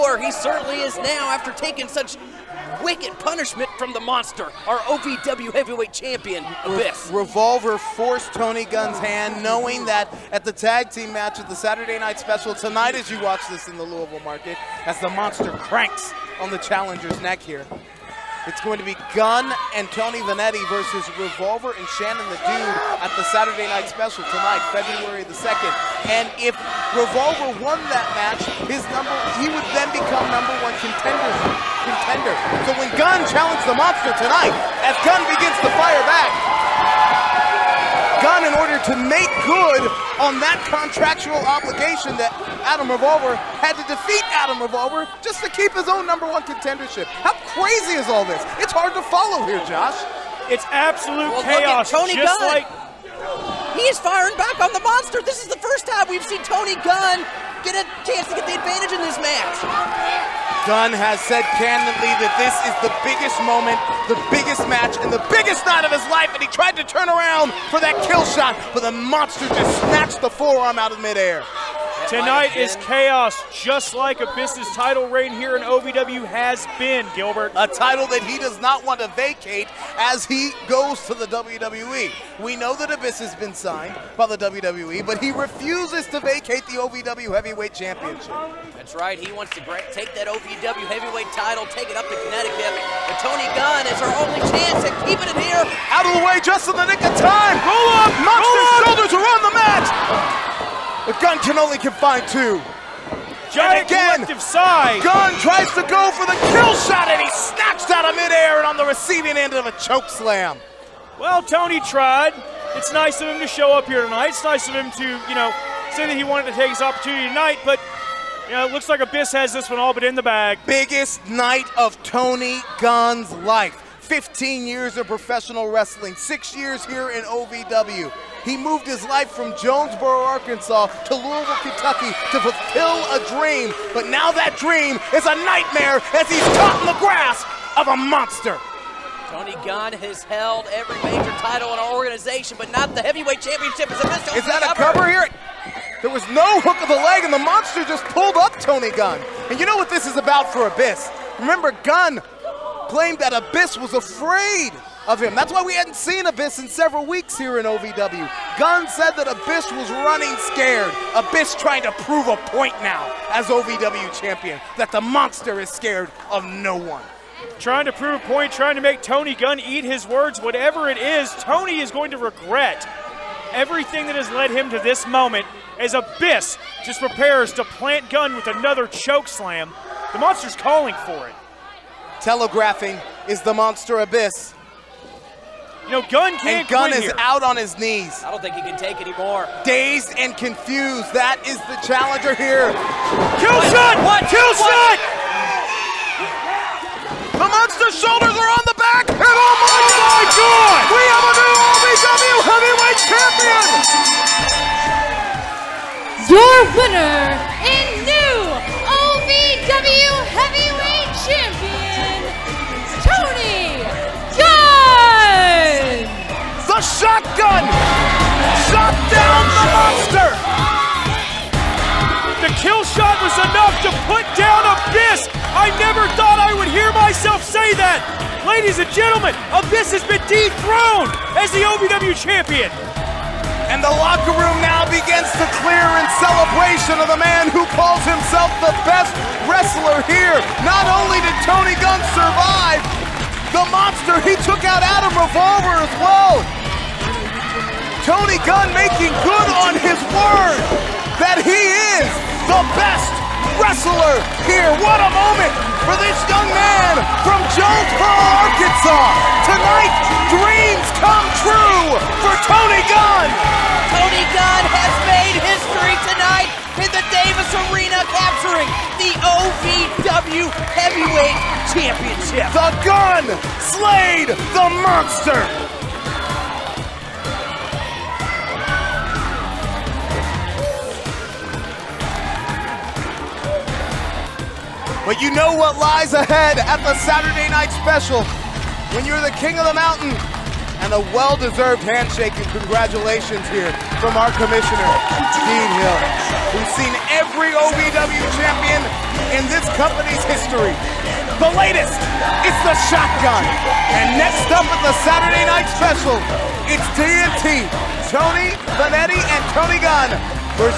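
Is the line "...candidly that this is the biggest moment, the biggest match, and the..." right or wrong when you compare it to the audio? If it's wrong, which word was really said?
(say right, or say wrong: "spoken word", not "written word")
right.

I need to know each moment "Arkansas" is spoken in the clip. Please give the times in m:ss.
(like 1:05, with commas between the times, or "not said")
2:10, 4:18.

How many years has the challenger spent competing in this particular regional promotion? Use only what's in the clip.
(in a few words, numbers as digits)
6 years.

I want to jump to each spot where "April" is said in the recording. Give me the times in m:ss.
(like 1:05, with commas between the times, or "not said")
not said.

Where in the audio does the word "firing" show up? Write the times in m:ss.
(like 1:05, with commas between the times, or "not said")
0:53.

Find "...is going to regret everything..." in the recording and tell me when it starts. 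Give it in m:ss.
2:51.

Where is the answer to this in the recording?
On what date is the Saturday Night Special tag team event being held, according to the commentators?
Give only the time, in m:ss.
0:24.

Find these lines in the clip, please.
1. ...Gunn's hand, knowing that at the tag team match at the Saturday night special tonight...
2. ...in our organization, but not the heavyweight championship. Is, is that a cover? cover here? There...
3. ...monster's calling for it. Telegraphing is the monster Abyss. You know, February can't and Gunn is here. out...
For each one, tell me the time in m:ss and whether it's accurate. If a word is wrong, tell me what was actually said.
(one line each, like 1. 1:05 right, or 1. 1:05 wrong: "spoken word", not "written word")
1. 0:08 right
2. 2:21 right
3. 3:00 wrong: "Gunn", not "February".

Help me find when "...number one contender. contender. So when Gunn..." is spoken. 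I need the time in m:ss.
0:30.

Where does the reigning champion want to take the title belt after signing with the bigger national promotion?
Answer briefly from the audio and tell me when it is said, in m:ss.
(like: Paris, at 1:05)
Connecticut, at 1:32.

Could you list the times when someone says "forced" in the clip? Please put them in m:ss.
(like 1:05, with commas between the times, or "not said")
0:07.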